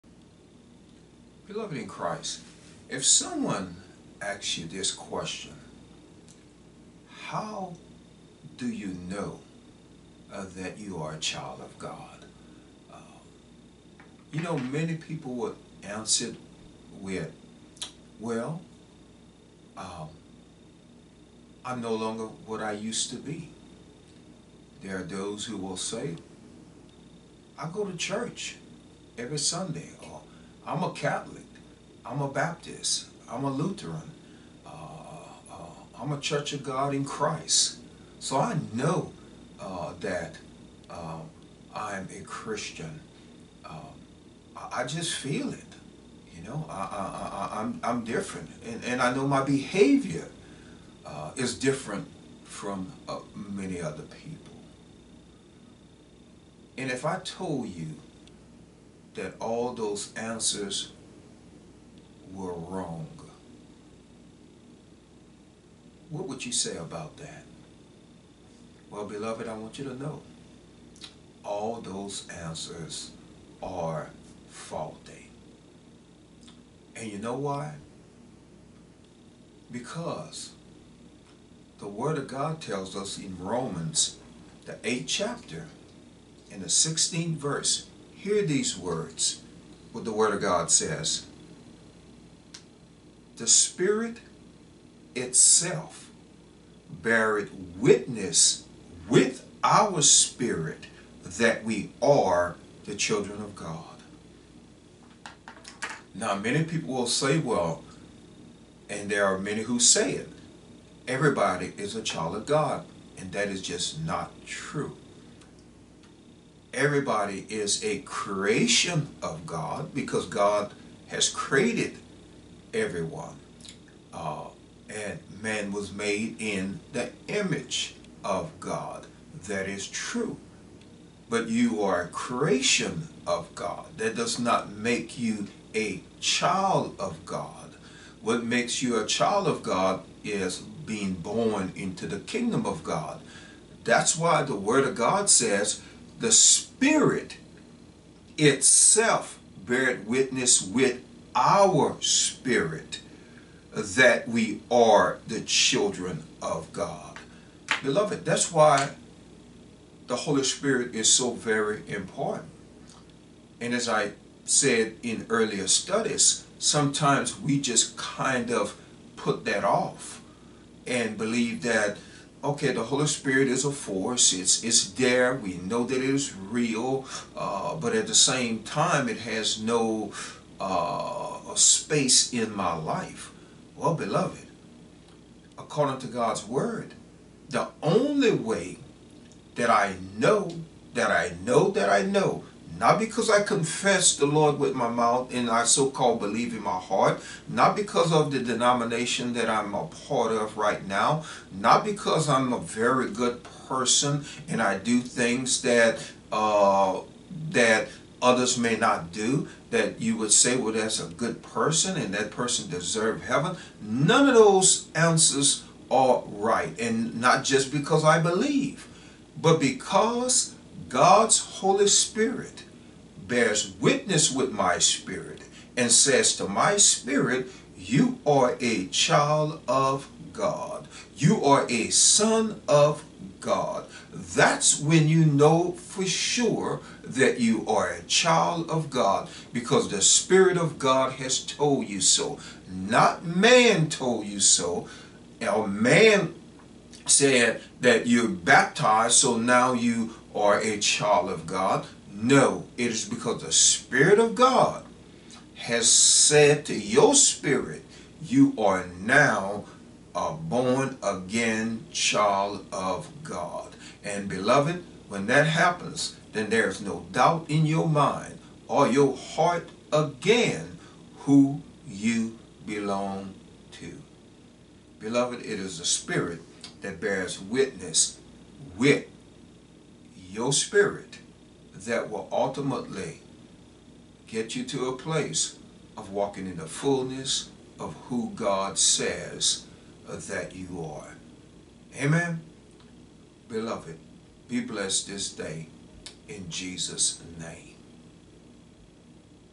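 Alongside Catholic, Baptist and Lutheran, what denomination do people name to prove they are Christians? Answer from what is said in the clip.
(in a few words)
Church of God in Christ.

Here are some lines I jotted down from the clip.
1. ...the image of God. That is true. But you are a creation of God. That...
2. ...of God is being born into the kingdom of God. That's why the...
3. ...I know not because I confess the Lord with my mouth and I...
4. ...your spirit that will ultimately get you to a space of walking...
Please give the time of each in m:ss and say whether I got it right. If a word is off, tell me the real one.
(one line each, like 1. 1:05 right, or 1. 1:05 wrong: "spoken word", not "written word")
1. 2:06 right
2. 2:19 right
3. 3:11 right
4. 4:40 wrong: "place", not "space".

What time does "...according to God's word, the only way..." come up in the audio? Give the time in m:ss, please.
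3:05.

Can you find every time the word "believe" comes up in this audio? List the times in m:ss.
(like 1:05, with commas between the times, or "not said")
2:51, 3:16, 3:38.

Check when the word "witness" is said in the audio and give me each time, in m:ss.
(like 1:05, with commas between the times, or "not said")
1:37, 2:30, 3:43, 4:37.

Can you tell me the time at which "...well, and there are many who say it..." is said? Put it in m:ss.
1:47.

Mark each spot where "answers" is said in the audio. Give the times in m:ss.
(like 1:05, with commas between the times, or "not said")
0:15, 1:00, 1:12, 3:34.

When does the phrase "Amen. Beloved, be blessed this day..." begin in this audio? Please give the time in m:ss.
4:52.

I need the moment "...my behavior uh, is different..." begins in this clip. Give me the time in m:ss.
0:49.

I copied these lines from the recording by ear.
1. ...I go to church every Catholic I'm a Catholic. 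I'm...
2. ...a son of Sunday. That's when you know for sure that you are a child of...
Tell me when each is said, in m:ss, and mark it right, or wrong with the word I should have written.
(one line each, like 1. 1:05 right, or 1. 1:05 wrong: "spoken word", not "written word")
1. 0:27 wrong: "Sunday", not "Catholic"
2. 3:51 wrong: "God", not "Sunday".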